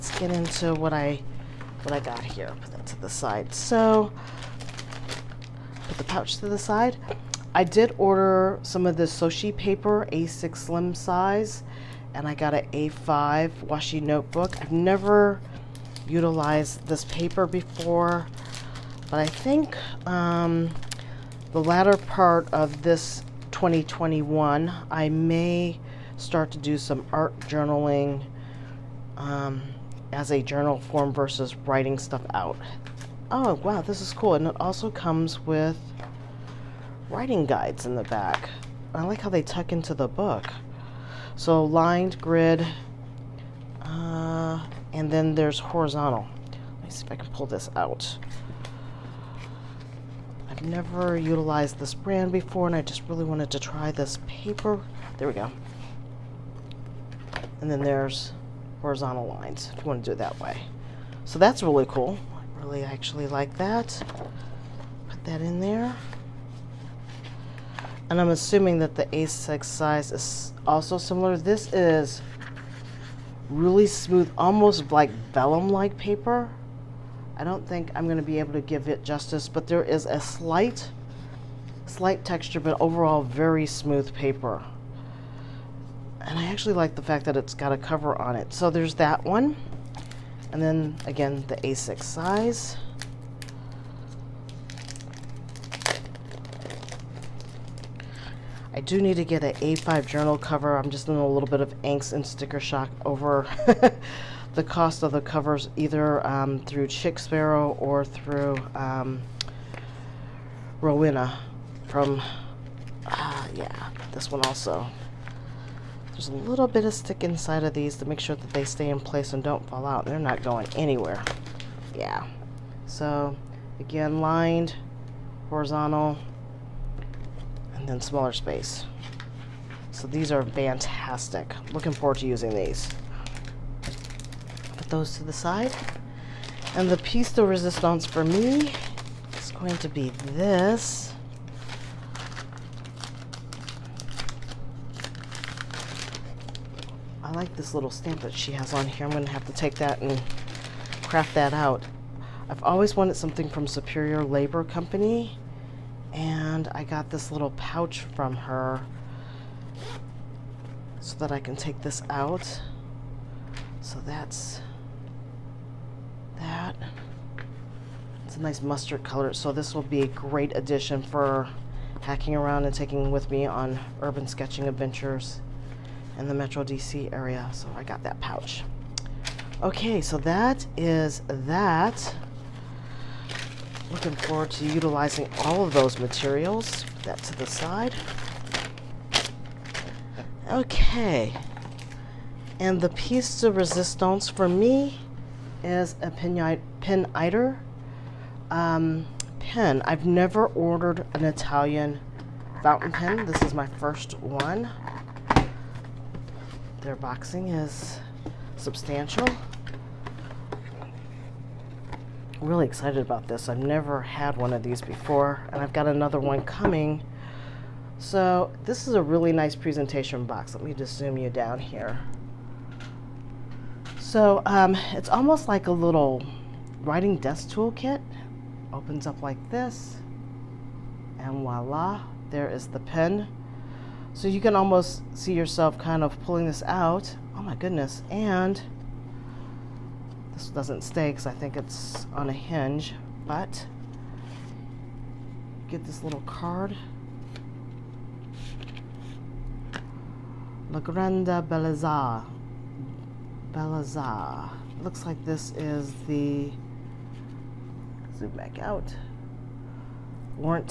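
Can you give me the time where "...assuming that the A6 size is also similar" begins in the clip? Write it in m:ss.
1:08.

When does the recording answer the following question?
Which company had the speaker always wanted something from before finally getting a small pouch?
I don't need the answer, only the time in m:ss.
2:33.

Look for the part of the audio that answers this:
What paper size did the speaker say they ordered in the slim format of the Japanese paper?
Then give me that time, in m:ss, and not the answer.
0:10.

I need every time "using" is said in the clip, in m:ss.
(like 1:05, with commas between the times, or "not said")
2:12.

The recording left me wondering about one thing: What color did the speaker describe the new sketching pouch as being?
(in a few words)
Mustard.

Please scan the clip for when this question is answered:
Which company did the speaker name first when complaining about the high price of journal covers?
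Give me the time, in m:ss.
1:46.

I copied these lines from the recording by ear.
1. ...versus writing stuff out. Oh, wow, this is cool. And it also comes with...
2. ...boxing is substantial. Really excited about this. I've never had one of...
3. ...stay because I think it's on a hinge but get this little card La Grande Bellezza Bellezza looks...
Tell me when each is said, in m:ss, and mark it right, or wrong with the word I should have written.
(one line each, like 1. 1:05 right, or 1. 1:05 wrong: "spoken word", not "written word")
1. 0:31 right
2. 3:26 right
3. 4:00 right.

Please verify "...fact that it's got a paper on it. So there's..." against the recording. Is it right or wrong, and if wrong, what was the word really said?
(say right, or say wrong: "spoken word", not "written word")
wrong: "cover", not "paper".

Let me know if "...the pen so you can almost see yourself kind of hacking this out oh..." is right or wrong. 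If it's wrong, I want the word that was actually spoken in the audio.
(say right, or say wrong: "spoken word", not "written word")
wrong: "pulling", not "hacking".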